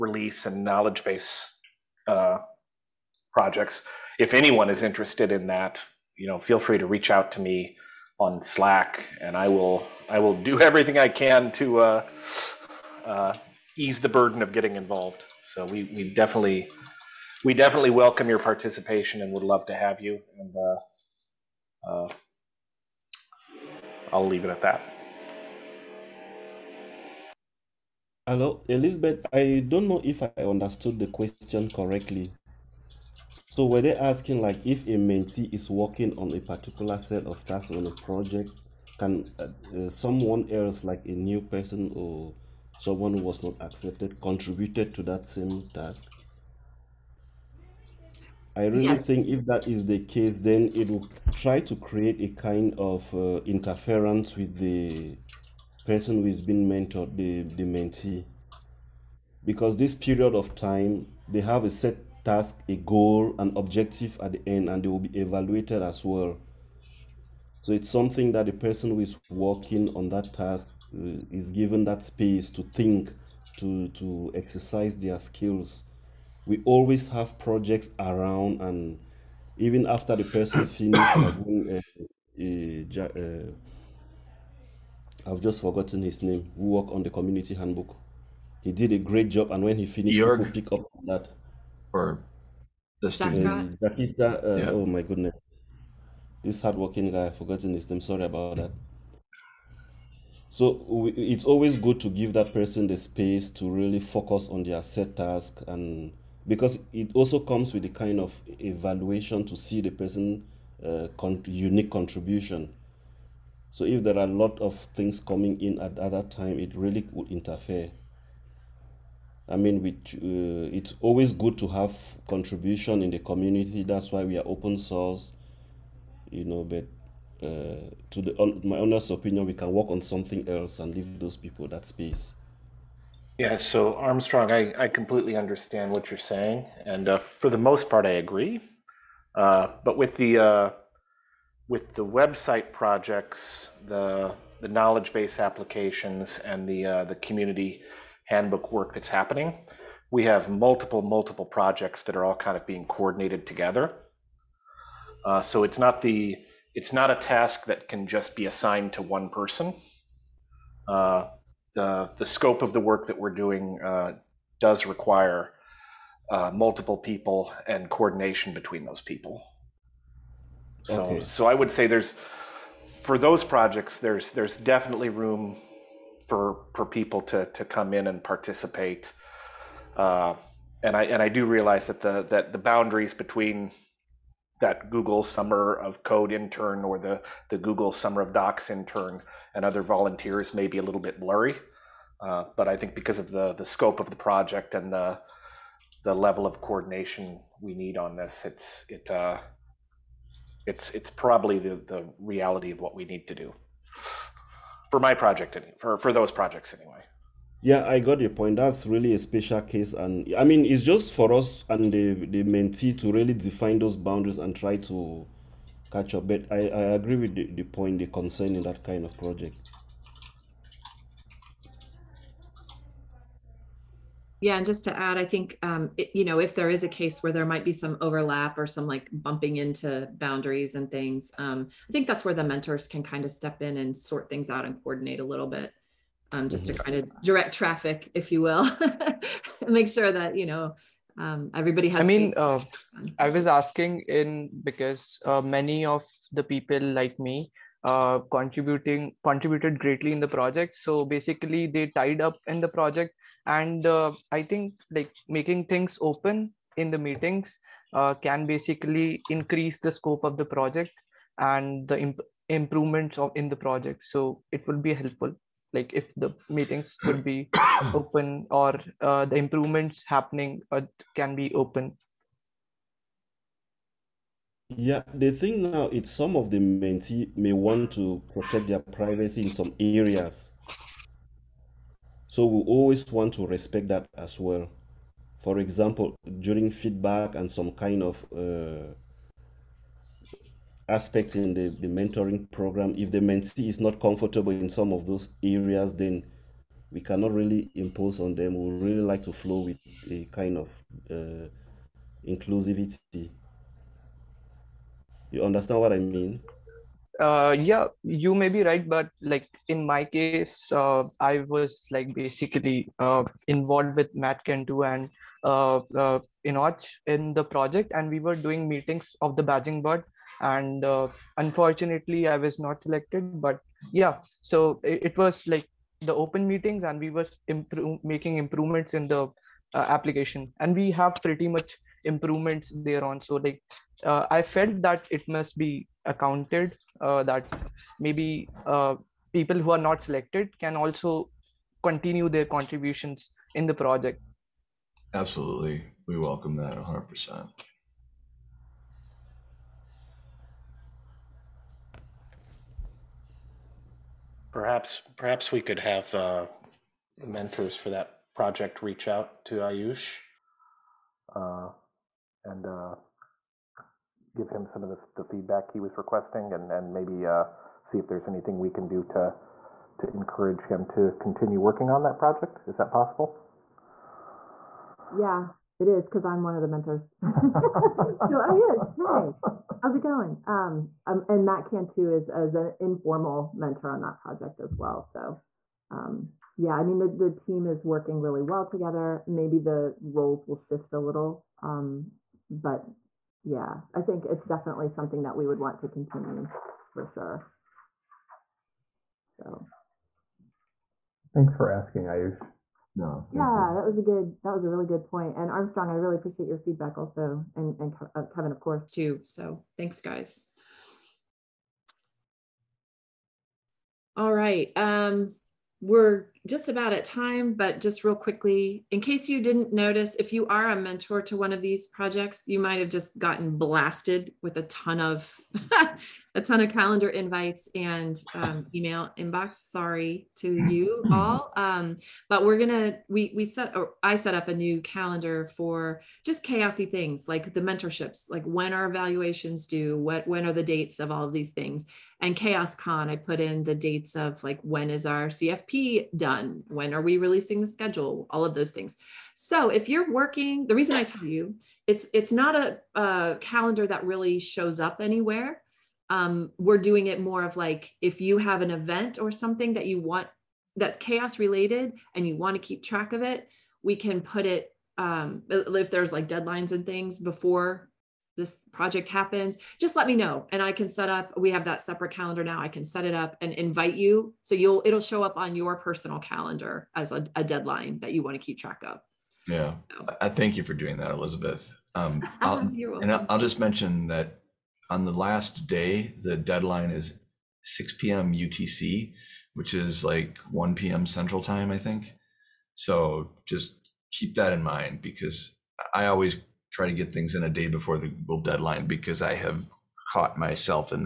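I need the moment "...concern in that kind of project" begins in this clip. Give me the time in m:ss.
3:38.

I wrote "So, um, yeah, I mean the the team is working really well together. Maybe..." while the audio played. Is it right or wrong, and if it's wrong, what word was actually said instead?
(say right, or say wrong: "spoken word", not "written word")
right.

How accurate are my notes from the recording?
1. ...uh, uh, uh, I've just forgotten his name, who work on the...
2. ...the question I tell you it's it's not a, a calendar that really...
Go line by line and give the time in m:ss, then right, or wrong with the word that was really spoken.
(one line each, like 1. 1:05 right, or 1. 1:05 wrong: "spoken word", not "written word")
1. 1:21 right
2. 7:30 wrong: "reason", not "question".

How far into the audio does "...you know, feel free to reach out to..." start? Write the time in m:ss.
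0:06.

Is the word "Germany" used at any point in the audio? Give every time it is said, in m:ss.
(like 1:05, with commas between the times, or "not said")
not said.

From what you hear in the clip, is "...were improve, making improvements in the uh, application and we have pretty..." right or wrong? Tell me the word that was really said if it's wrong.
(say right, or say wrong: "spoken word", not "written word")
right.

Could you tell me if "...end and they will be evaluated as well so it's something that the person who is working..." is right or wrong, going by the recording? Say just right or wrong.
right.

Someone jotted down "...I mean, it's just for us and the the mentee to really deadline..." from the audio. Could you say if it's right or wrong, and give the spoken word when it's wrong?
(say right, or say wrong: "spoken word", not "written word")
wrong: "define", not "deadline".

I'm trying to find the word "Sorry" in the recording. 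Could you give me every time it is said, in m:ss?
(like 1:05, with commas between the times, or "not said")
1:38, 7:09.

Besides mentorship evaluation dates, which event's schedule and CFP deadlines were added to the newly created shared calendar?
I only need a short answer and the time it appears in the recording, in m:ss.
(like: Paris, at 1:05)
CHAOSScon, at 7:22.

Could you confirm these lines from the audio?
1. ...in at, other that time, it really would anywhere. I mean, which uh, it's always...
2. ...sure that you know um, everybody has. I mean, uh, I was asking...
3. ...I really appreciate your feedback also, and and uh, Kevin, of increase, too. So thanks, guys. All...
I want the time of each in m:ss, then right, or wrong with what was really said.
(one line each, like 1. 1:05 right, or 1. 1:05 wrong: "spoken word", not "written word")
1. 1:55 wrong: "interfere", not "anywhere"
2. 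3:59 right
3. 6:45 wrong: "course", not "increase".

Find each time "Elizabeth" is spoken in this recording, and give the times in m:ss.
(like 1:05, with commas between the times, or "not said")
0:28, 8:01.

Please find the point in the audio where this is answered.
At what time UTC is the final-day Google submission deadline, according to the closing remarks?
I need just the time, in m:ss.
8:07.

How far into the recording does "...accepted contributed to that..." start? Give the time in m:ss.
0:43.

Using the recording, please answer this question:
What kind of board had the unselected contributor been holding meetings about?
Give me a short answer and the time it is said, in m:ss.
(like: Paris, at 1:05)
badging board, at 5:19.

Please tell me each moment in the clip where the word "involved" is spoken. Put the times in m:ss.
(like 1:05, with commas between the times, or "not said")
0:14, 5:13.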